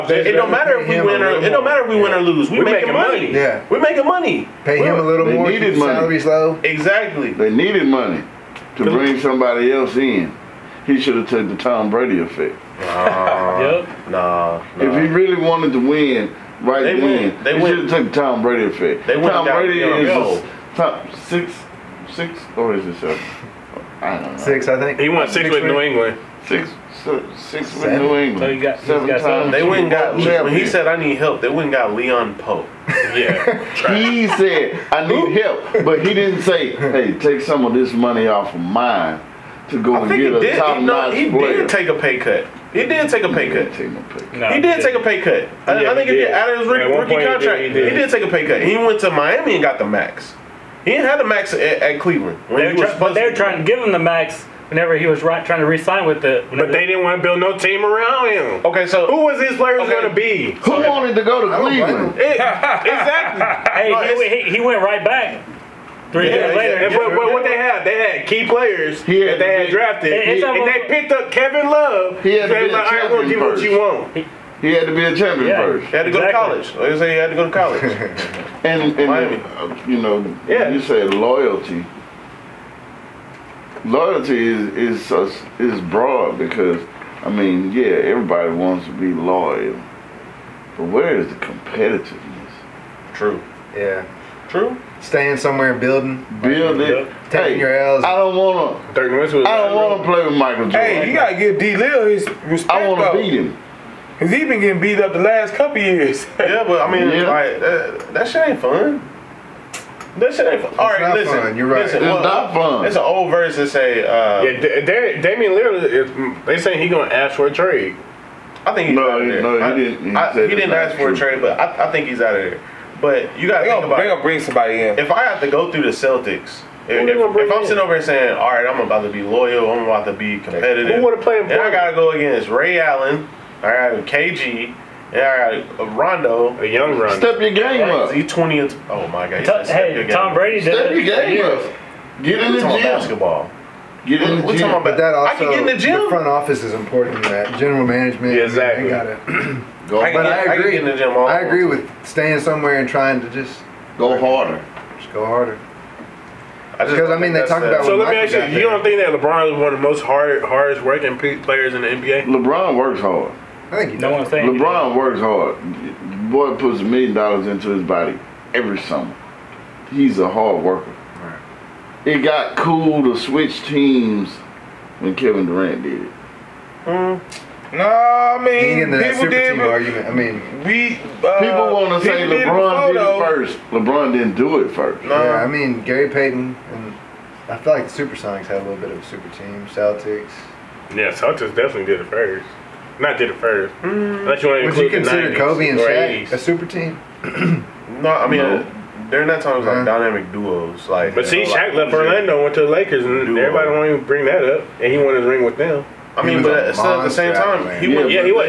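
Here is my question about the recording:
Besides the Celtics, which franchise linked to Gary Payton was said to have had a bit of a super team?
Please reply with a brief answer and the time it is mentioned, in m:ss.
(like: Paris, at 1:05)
Supersonics, at 3:08.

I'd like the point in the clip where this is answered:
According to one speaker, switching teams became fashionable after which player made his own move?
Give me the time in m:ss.
2:55.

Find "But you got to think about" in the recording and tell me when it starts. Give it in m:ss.
2:03.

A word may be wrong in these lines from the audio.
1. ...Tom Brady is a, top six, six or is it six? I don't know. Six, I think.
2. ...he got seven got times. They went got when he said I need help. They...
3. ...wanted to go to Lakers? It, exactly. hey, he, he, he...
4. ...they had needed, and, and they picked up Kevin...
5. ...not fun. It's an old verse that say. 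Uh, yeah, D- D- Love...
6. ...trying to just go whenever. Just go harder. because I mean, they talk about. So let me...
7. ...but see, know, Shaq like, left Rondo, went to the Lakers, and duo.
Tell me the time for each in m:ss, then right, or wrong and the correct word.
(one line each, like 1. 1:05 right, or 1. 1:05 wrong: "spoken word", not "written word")
1. 0:19 wrong: "seven", not "six"
2. 0:28 right
3. 1:00 wrong: "Cleveland", not "Lakers"
4. 1:09 wrong: "drafted", not "needed"
5. 1:52 wrong: "Damian", not "Love"
6. 2:32 wrong: "harder", not "whenever"
7. 3:21 wrong: "Orlando", not "Rondo".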